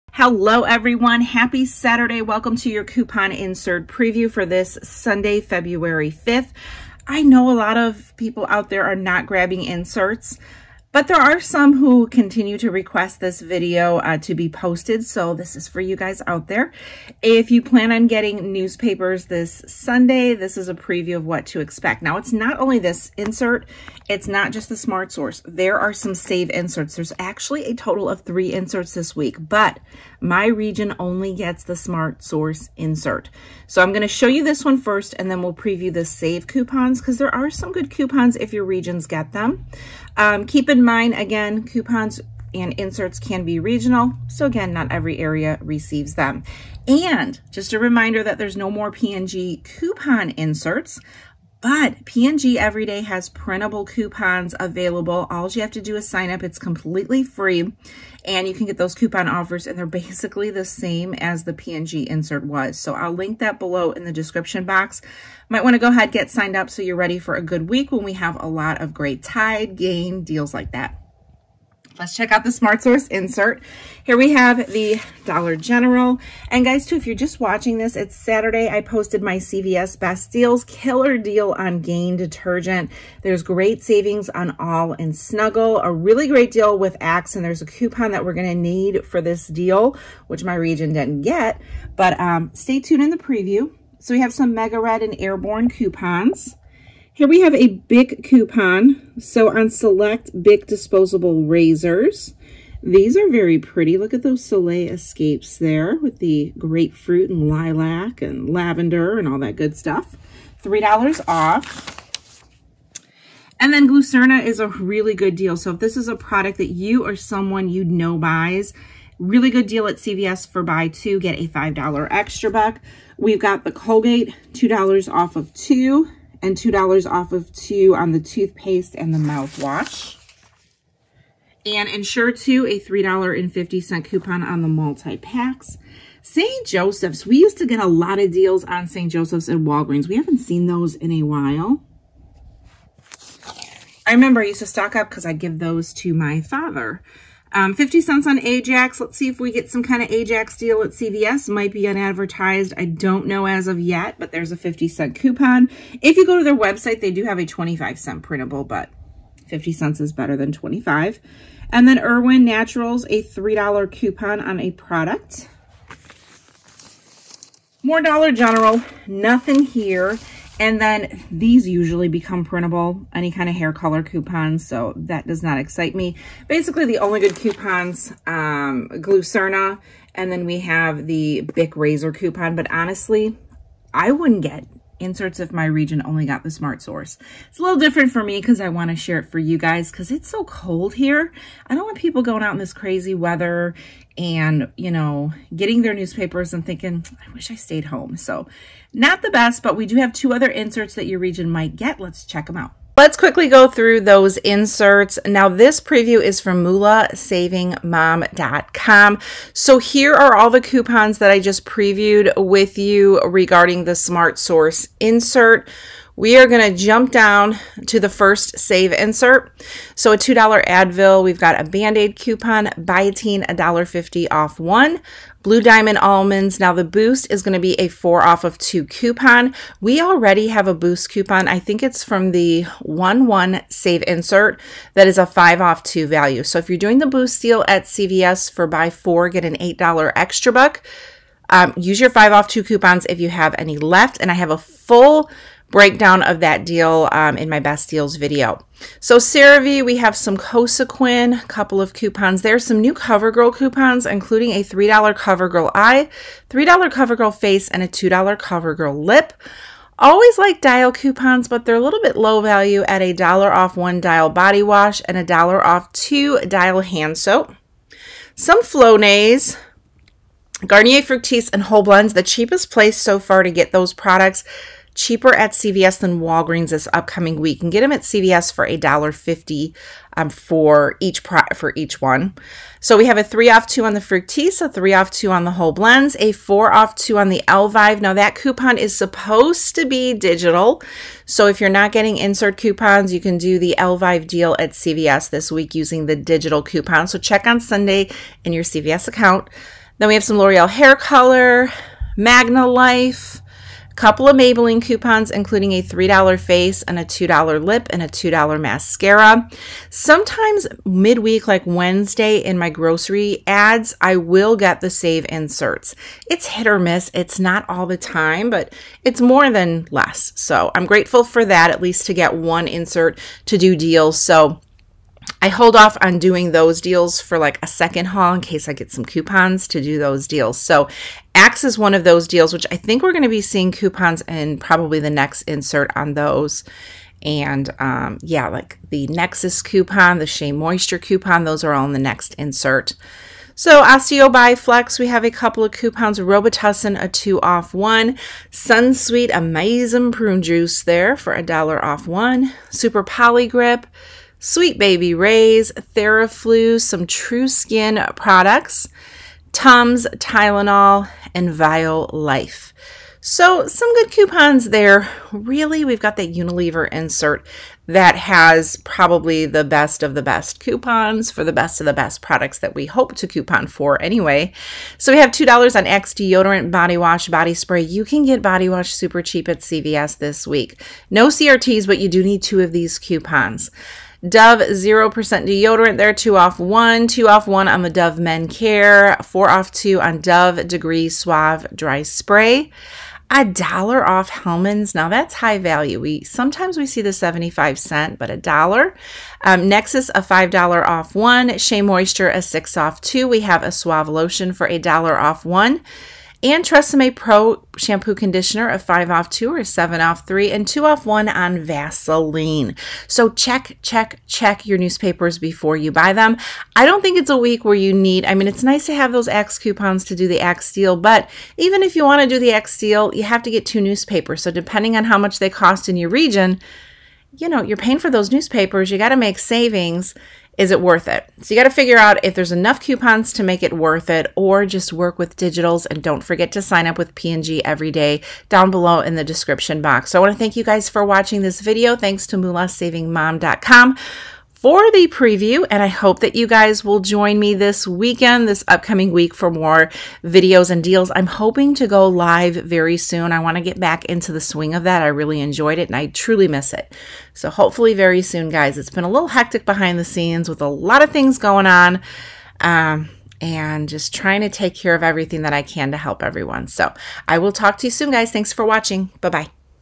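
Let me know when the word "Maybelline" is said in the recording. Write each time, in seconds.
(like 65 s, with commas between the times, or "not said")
304 s.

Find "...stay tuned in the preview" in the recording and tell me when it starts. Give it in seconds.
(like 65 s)
92 s.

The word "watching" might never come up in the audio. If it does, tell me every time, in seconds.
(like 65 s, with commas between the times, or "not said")
77 s, 441 s, 468 s.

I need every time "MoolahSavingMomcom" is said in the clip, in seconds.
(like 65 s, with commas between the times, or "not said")
206 s, 442 s.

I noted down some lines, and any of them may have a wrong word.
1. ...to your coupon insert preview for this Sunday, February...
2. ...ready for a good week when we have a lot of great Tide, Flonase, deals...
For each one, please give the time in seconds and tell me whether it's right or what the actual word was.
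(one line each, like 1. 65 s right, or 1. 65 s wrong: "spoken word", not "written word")
1. 2 s right
2. 66 s wrong: "Gain", not "Flonase".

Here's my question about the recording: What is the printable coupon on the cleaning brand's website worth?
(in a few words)
25 cents.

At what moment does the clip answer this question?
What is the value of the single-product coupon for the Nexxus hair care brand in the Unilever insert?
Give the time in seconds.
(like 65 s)
400 s.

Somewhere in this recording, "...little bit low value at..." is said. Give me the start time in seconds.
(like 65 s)
261 s.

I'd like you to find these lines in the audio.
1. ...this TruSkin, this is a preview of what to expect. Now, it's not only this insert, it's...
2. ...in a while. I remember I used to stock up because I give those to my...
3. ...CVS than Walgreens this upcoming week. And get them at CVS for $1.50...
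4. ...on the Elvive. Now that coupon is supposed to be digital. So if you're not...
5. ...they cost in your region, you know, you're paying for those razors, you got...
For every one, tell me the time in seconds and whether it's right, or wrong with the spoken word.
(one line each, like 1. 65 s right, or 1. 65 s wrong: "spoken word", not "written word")
1. 19 s wrong: "Sunday", not "TruSkin"
2. 140 s right
3. 275 s right
4. 287 s right
5. 425 s wrong: "newspapers", not "razors".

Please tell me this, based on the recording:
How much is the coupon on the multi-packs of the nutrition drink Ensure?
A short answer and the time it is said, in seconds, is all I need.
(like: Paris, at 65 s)
$3.50, at 132 s.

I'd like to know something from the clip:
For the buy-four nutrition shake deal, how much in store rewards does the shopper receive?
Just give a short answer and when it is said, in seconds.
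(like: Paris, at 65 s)
$8, at 239 s.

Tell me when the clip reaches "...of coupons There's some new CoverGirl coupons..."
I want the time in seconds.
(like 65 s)
251 s.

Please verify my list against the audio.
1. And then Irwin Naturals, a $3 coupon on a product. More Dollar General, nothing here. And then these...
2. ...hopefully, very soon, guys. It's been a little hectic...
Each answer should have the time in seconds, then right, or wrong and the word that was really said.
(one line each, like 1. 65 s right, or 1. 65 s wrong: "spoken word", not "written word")
1. 161 s right
2. 457 s right.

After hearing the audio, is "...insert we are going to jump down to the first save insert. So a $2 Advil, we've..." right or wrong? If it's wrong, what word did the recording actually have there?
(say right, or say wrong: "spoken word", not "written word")
right.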